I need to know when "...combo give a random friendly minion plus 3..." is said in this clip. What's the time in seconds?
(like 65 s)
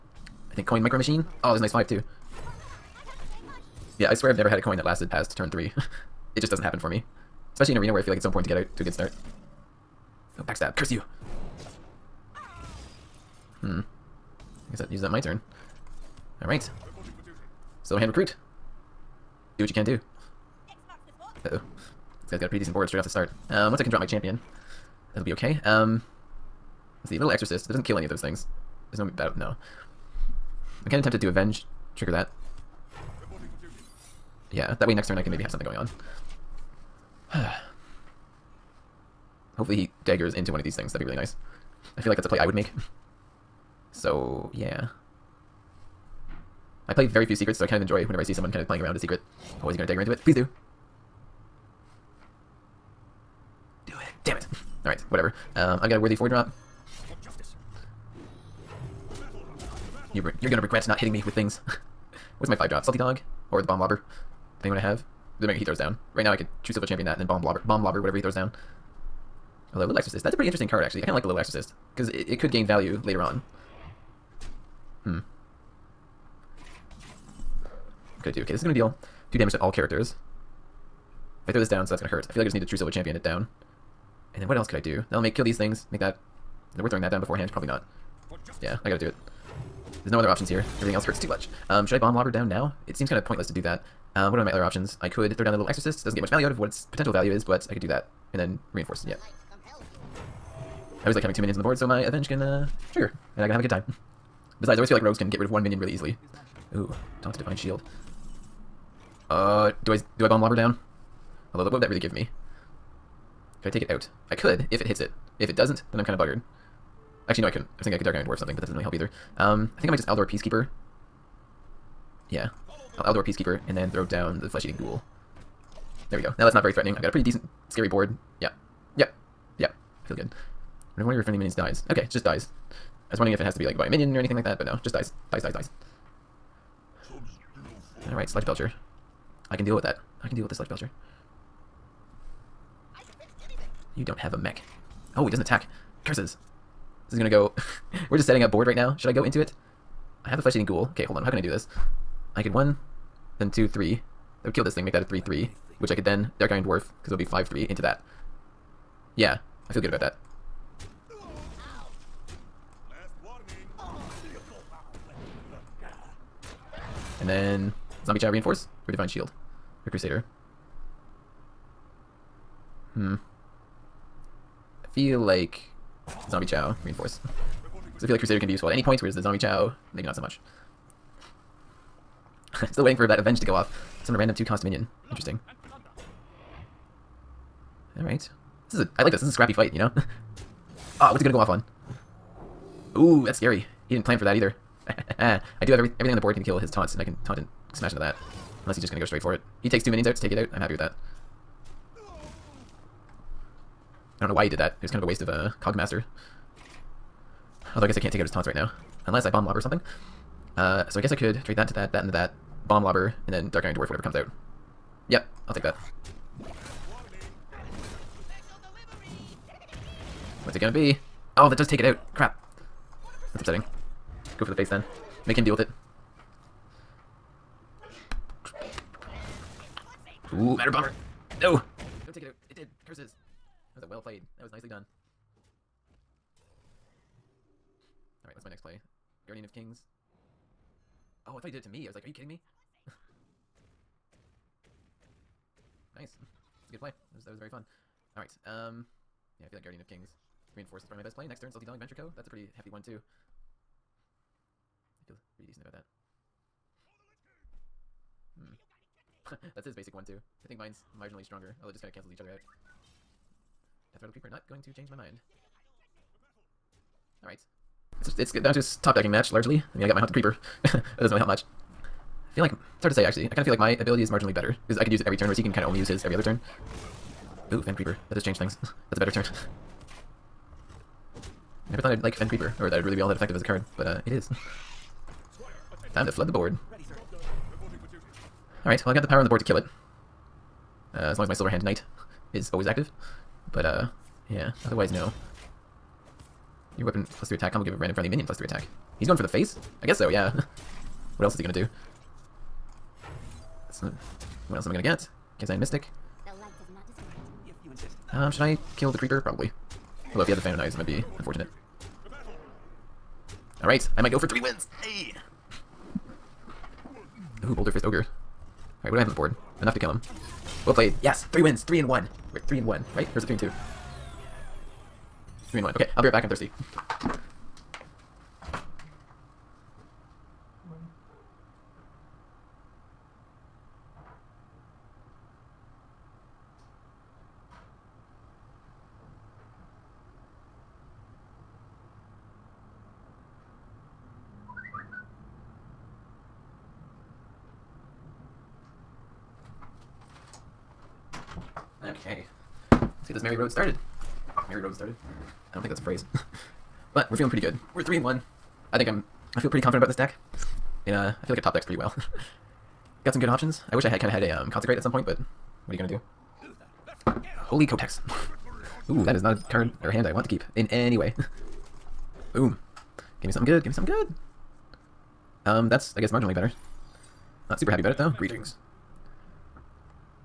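297 s.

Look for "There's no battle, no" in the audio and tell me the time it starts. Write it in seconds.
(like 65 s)
28 s.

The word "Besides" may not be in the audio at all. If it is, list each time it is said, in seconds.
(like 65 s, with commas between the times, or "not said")
104 s.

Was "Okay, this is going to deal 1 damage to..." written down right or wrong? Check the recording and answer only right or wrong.
wrong.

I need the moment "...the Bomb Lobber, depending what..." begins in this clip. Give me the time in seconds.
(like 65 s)
63 s.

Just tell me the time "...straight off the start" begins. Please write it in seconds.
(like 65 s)
22 s.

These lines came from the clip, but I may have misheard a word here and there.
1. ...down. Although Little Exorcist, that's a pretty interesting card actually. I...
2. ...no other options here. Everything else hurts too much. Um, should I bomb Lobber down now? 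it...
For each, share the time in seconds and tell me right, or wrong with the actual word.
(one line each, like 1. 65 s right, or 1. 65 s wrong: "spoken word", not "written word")
1. 68 s right
2. 90 s right.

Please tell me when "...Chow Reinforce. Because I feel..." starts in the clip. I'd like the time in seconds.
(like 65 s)
176 s.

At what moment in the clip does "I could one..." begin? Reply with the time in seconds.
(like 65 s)
152 s.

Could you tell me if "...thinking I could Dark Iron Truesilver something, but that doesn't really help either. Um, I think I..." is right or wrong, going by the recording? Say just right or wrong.
wrong.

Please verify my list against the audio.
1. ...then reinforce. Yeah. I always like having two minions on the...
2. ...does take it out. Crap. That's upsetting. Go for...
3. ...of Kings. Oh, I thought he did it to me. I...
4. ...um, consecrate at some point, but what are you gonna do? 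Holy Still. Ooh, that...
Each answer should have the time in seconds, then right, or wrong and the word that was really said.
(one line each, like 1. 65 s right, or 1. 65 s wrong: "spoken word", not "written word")
1. 98 s right
2. 221 s right
3. 239 s right
4. 364 s wrong: "Kotex", not "Still".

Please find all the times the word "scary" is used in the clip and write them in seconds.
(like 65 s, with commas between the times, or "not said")
127 s, 193 s.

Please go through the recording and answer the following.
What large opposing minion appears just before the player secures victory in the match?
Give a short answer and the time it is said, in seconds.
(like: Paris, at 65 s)
Boulderfist Ogre, at 317 s.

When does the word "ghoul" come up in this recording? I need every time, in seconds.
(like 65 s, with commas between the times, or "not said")
124 s, 150 s.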